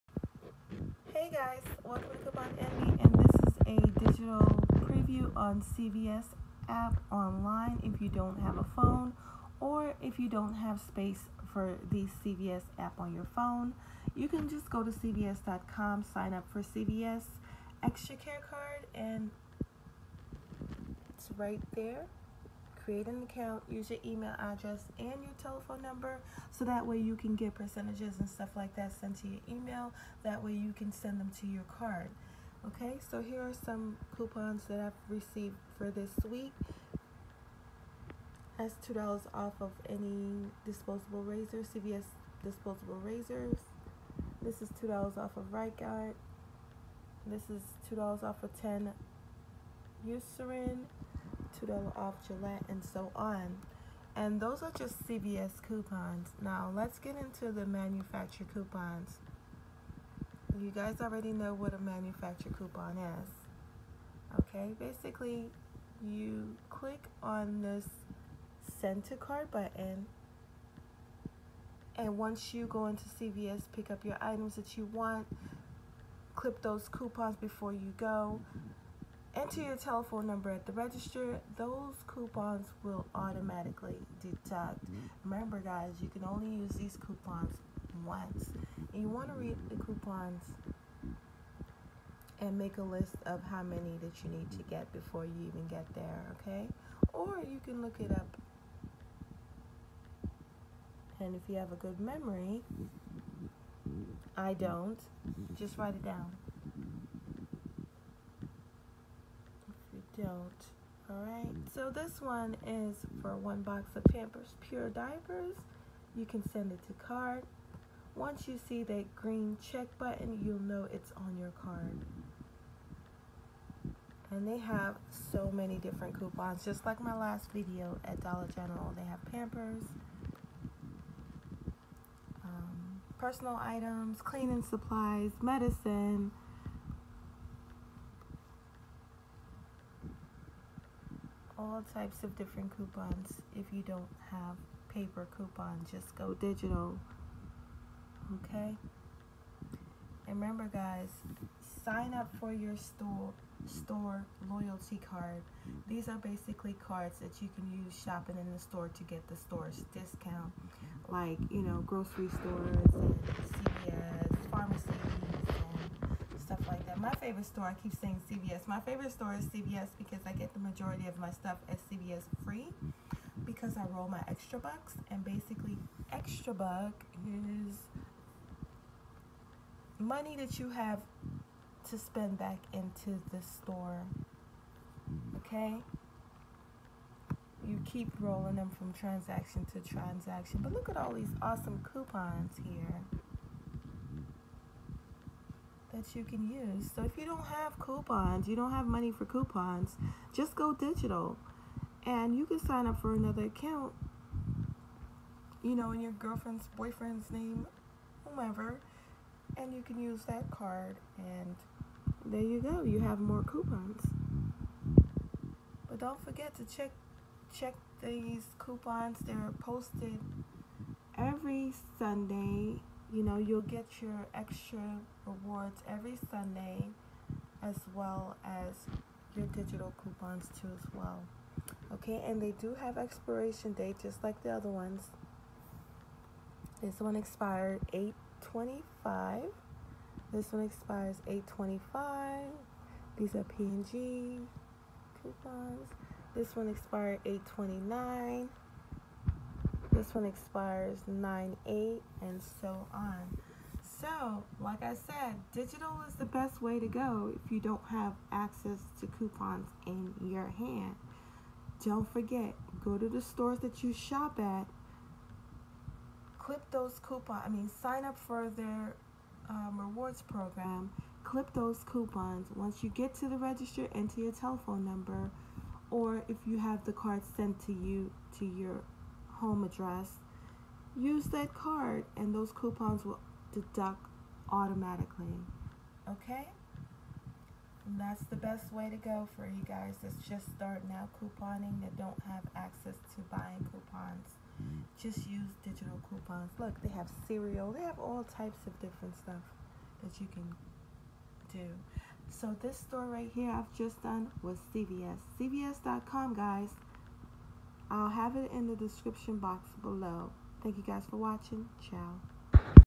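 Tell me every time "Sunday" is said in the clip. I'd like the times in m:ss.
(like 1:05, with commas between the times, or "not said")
3:41, 3:46.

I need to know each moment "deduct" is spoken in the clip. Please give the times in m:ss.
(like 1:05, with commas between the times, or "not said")
1:24, 4:43.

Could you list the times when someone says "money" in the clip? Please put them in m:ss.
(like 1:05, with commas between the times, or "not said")
2:59, 3:18.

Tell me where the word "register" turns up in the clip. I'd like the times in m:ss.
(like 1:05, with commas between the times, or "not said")
1:20, 4:33.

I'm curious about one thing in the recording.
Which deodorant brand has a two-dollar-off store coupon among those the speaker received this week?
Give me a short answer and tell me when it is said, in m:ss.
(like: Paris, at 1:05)
Right Guard, at 0:45.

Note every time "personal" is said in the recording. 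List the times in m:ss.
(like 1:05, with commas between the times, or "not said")
2:13.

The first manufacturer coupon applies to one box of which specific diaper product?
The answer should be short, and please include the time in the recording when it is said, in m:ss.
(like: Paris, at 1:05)
Pampers Pure Diapers, at 1:54.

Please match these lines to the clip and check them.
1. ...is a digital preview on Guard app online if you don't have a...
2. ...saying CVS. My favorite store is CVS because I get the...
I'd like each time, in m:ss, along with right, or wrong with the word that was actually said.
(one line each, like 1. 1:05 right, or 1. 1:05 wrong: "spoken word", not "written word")
1. 0:03 wrong: "CVS", not "Guard"
2. 2:48 right.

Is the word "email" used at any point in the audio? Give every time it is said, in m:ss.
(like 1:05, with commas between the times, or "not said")
0:24, 0:29.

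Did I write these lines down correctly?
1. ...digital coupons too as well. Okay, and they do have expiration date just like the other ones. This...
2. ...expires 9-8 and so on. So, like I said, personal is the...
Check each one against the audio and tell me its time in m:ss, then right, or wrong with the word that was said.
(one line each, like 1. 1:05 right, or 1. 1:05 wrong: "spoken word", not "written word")
1. 3:49 right
2. 4:10 wrong: "digital", not "personal".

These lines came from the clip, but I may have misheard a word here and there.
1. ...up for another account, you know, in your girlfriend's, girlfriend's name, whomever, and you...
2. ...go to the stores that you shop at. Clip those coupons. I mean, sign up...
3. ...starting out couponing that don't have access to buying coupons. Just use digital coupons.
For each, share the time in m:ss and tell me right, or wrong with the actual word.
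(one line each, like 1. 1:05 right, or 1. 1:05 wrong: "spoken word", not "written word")
1. 3:22 wrong: "boyfriend", not "girlfriend"
2. 4:22 right
3. 4:50 right.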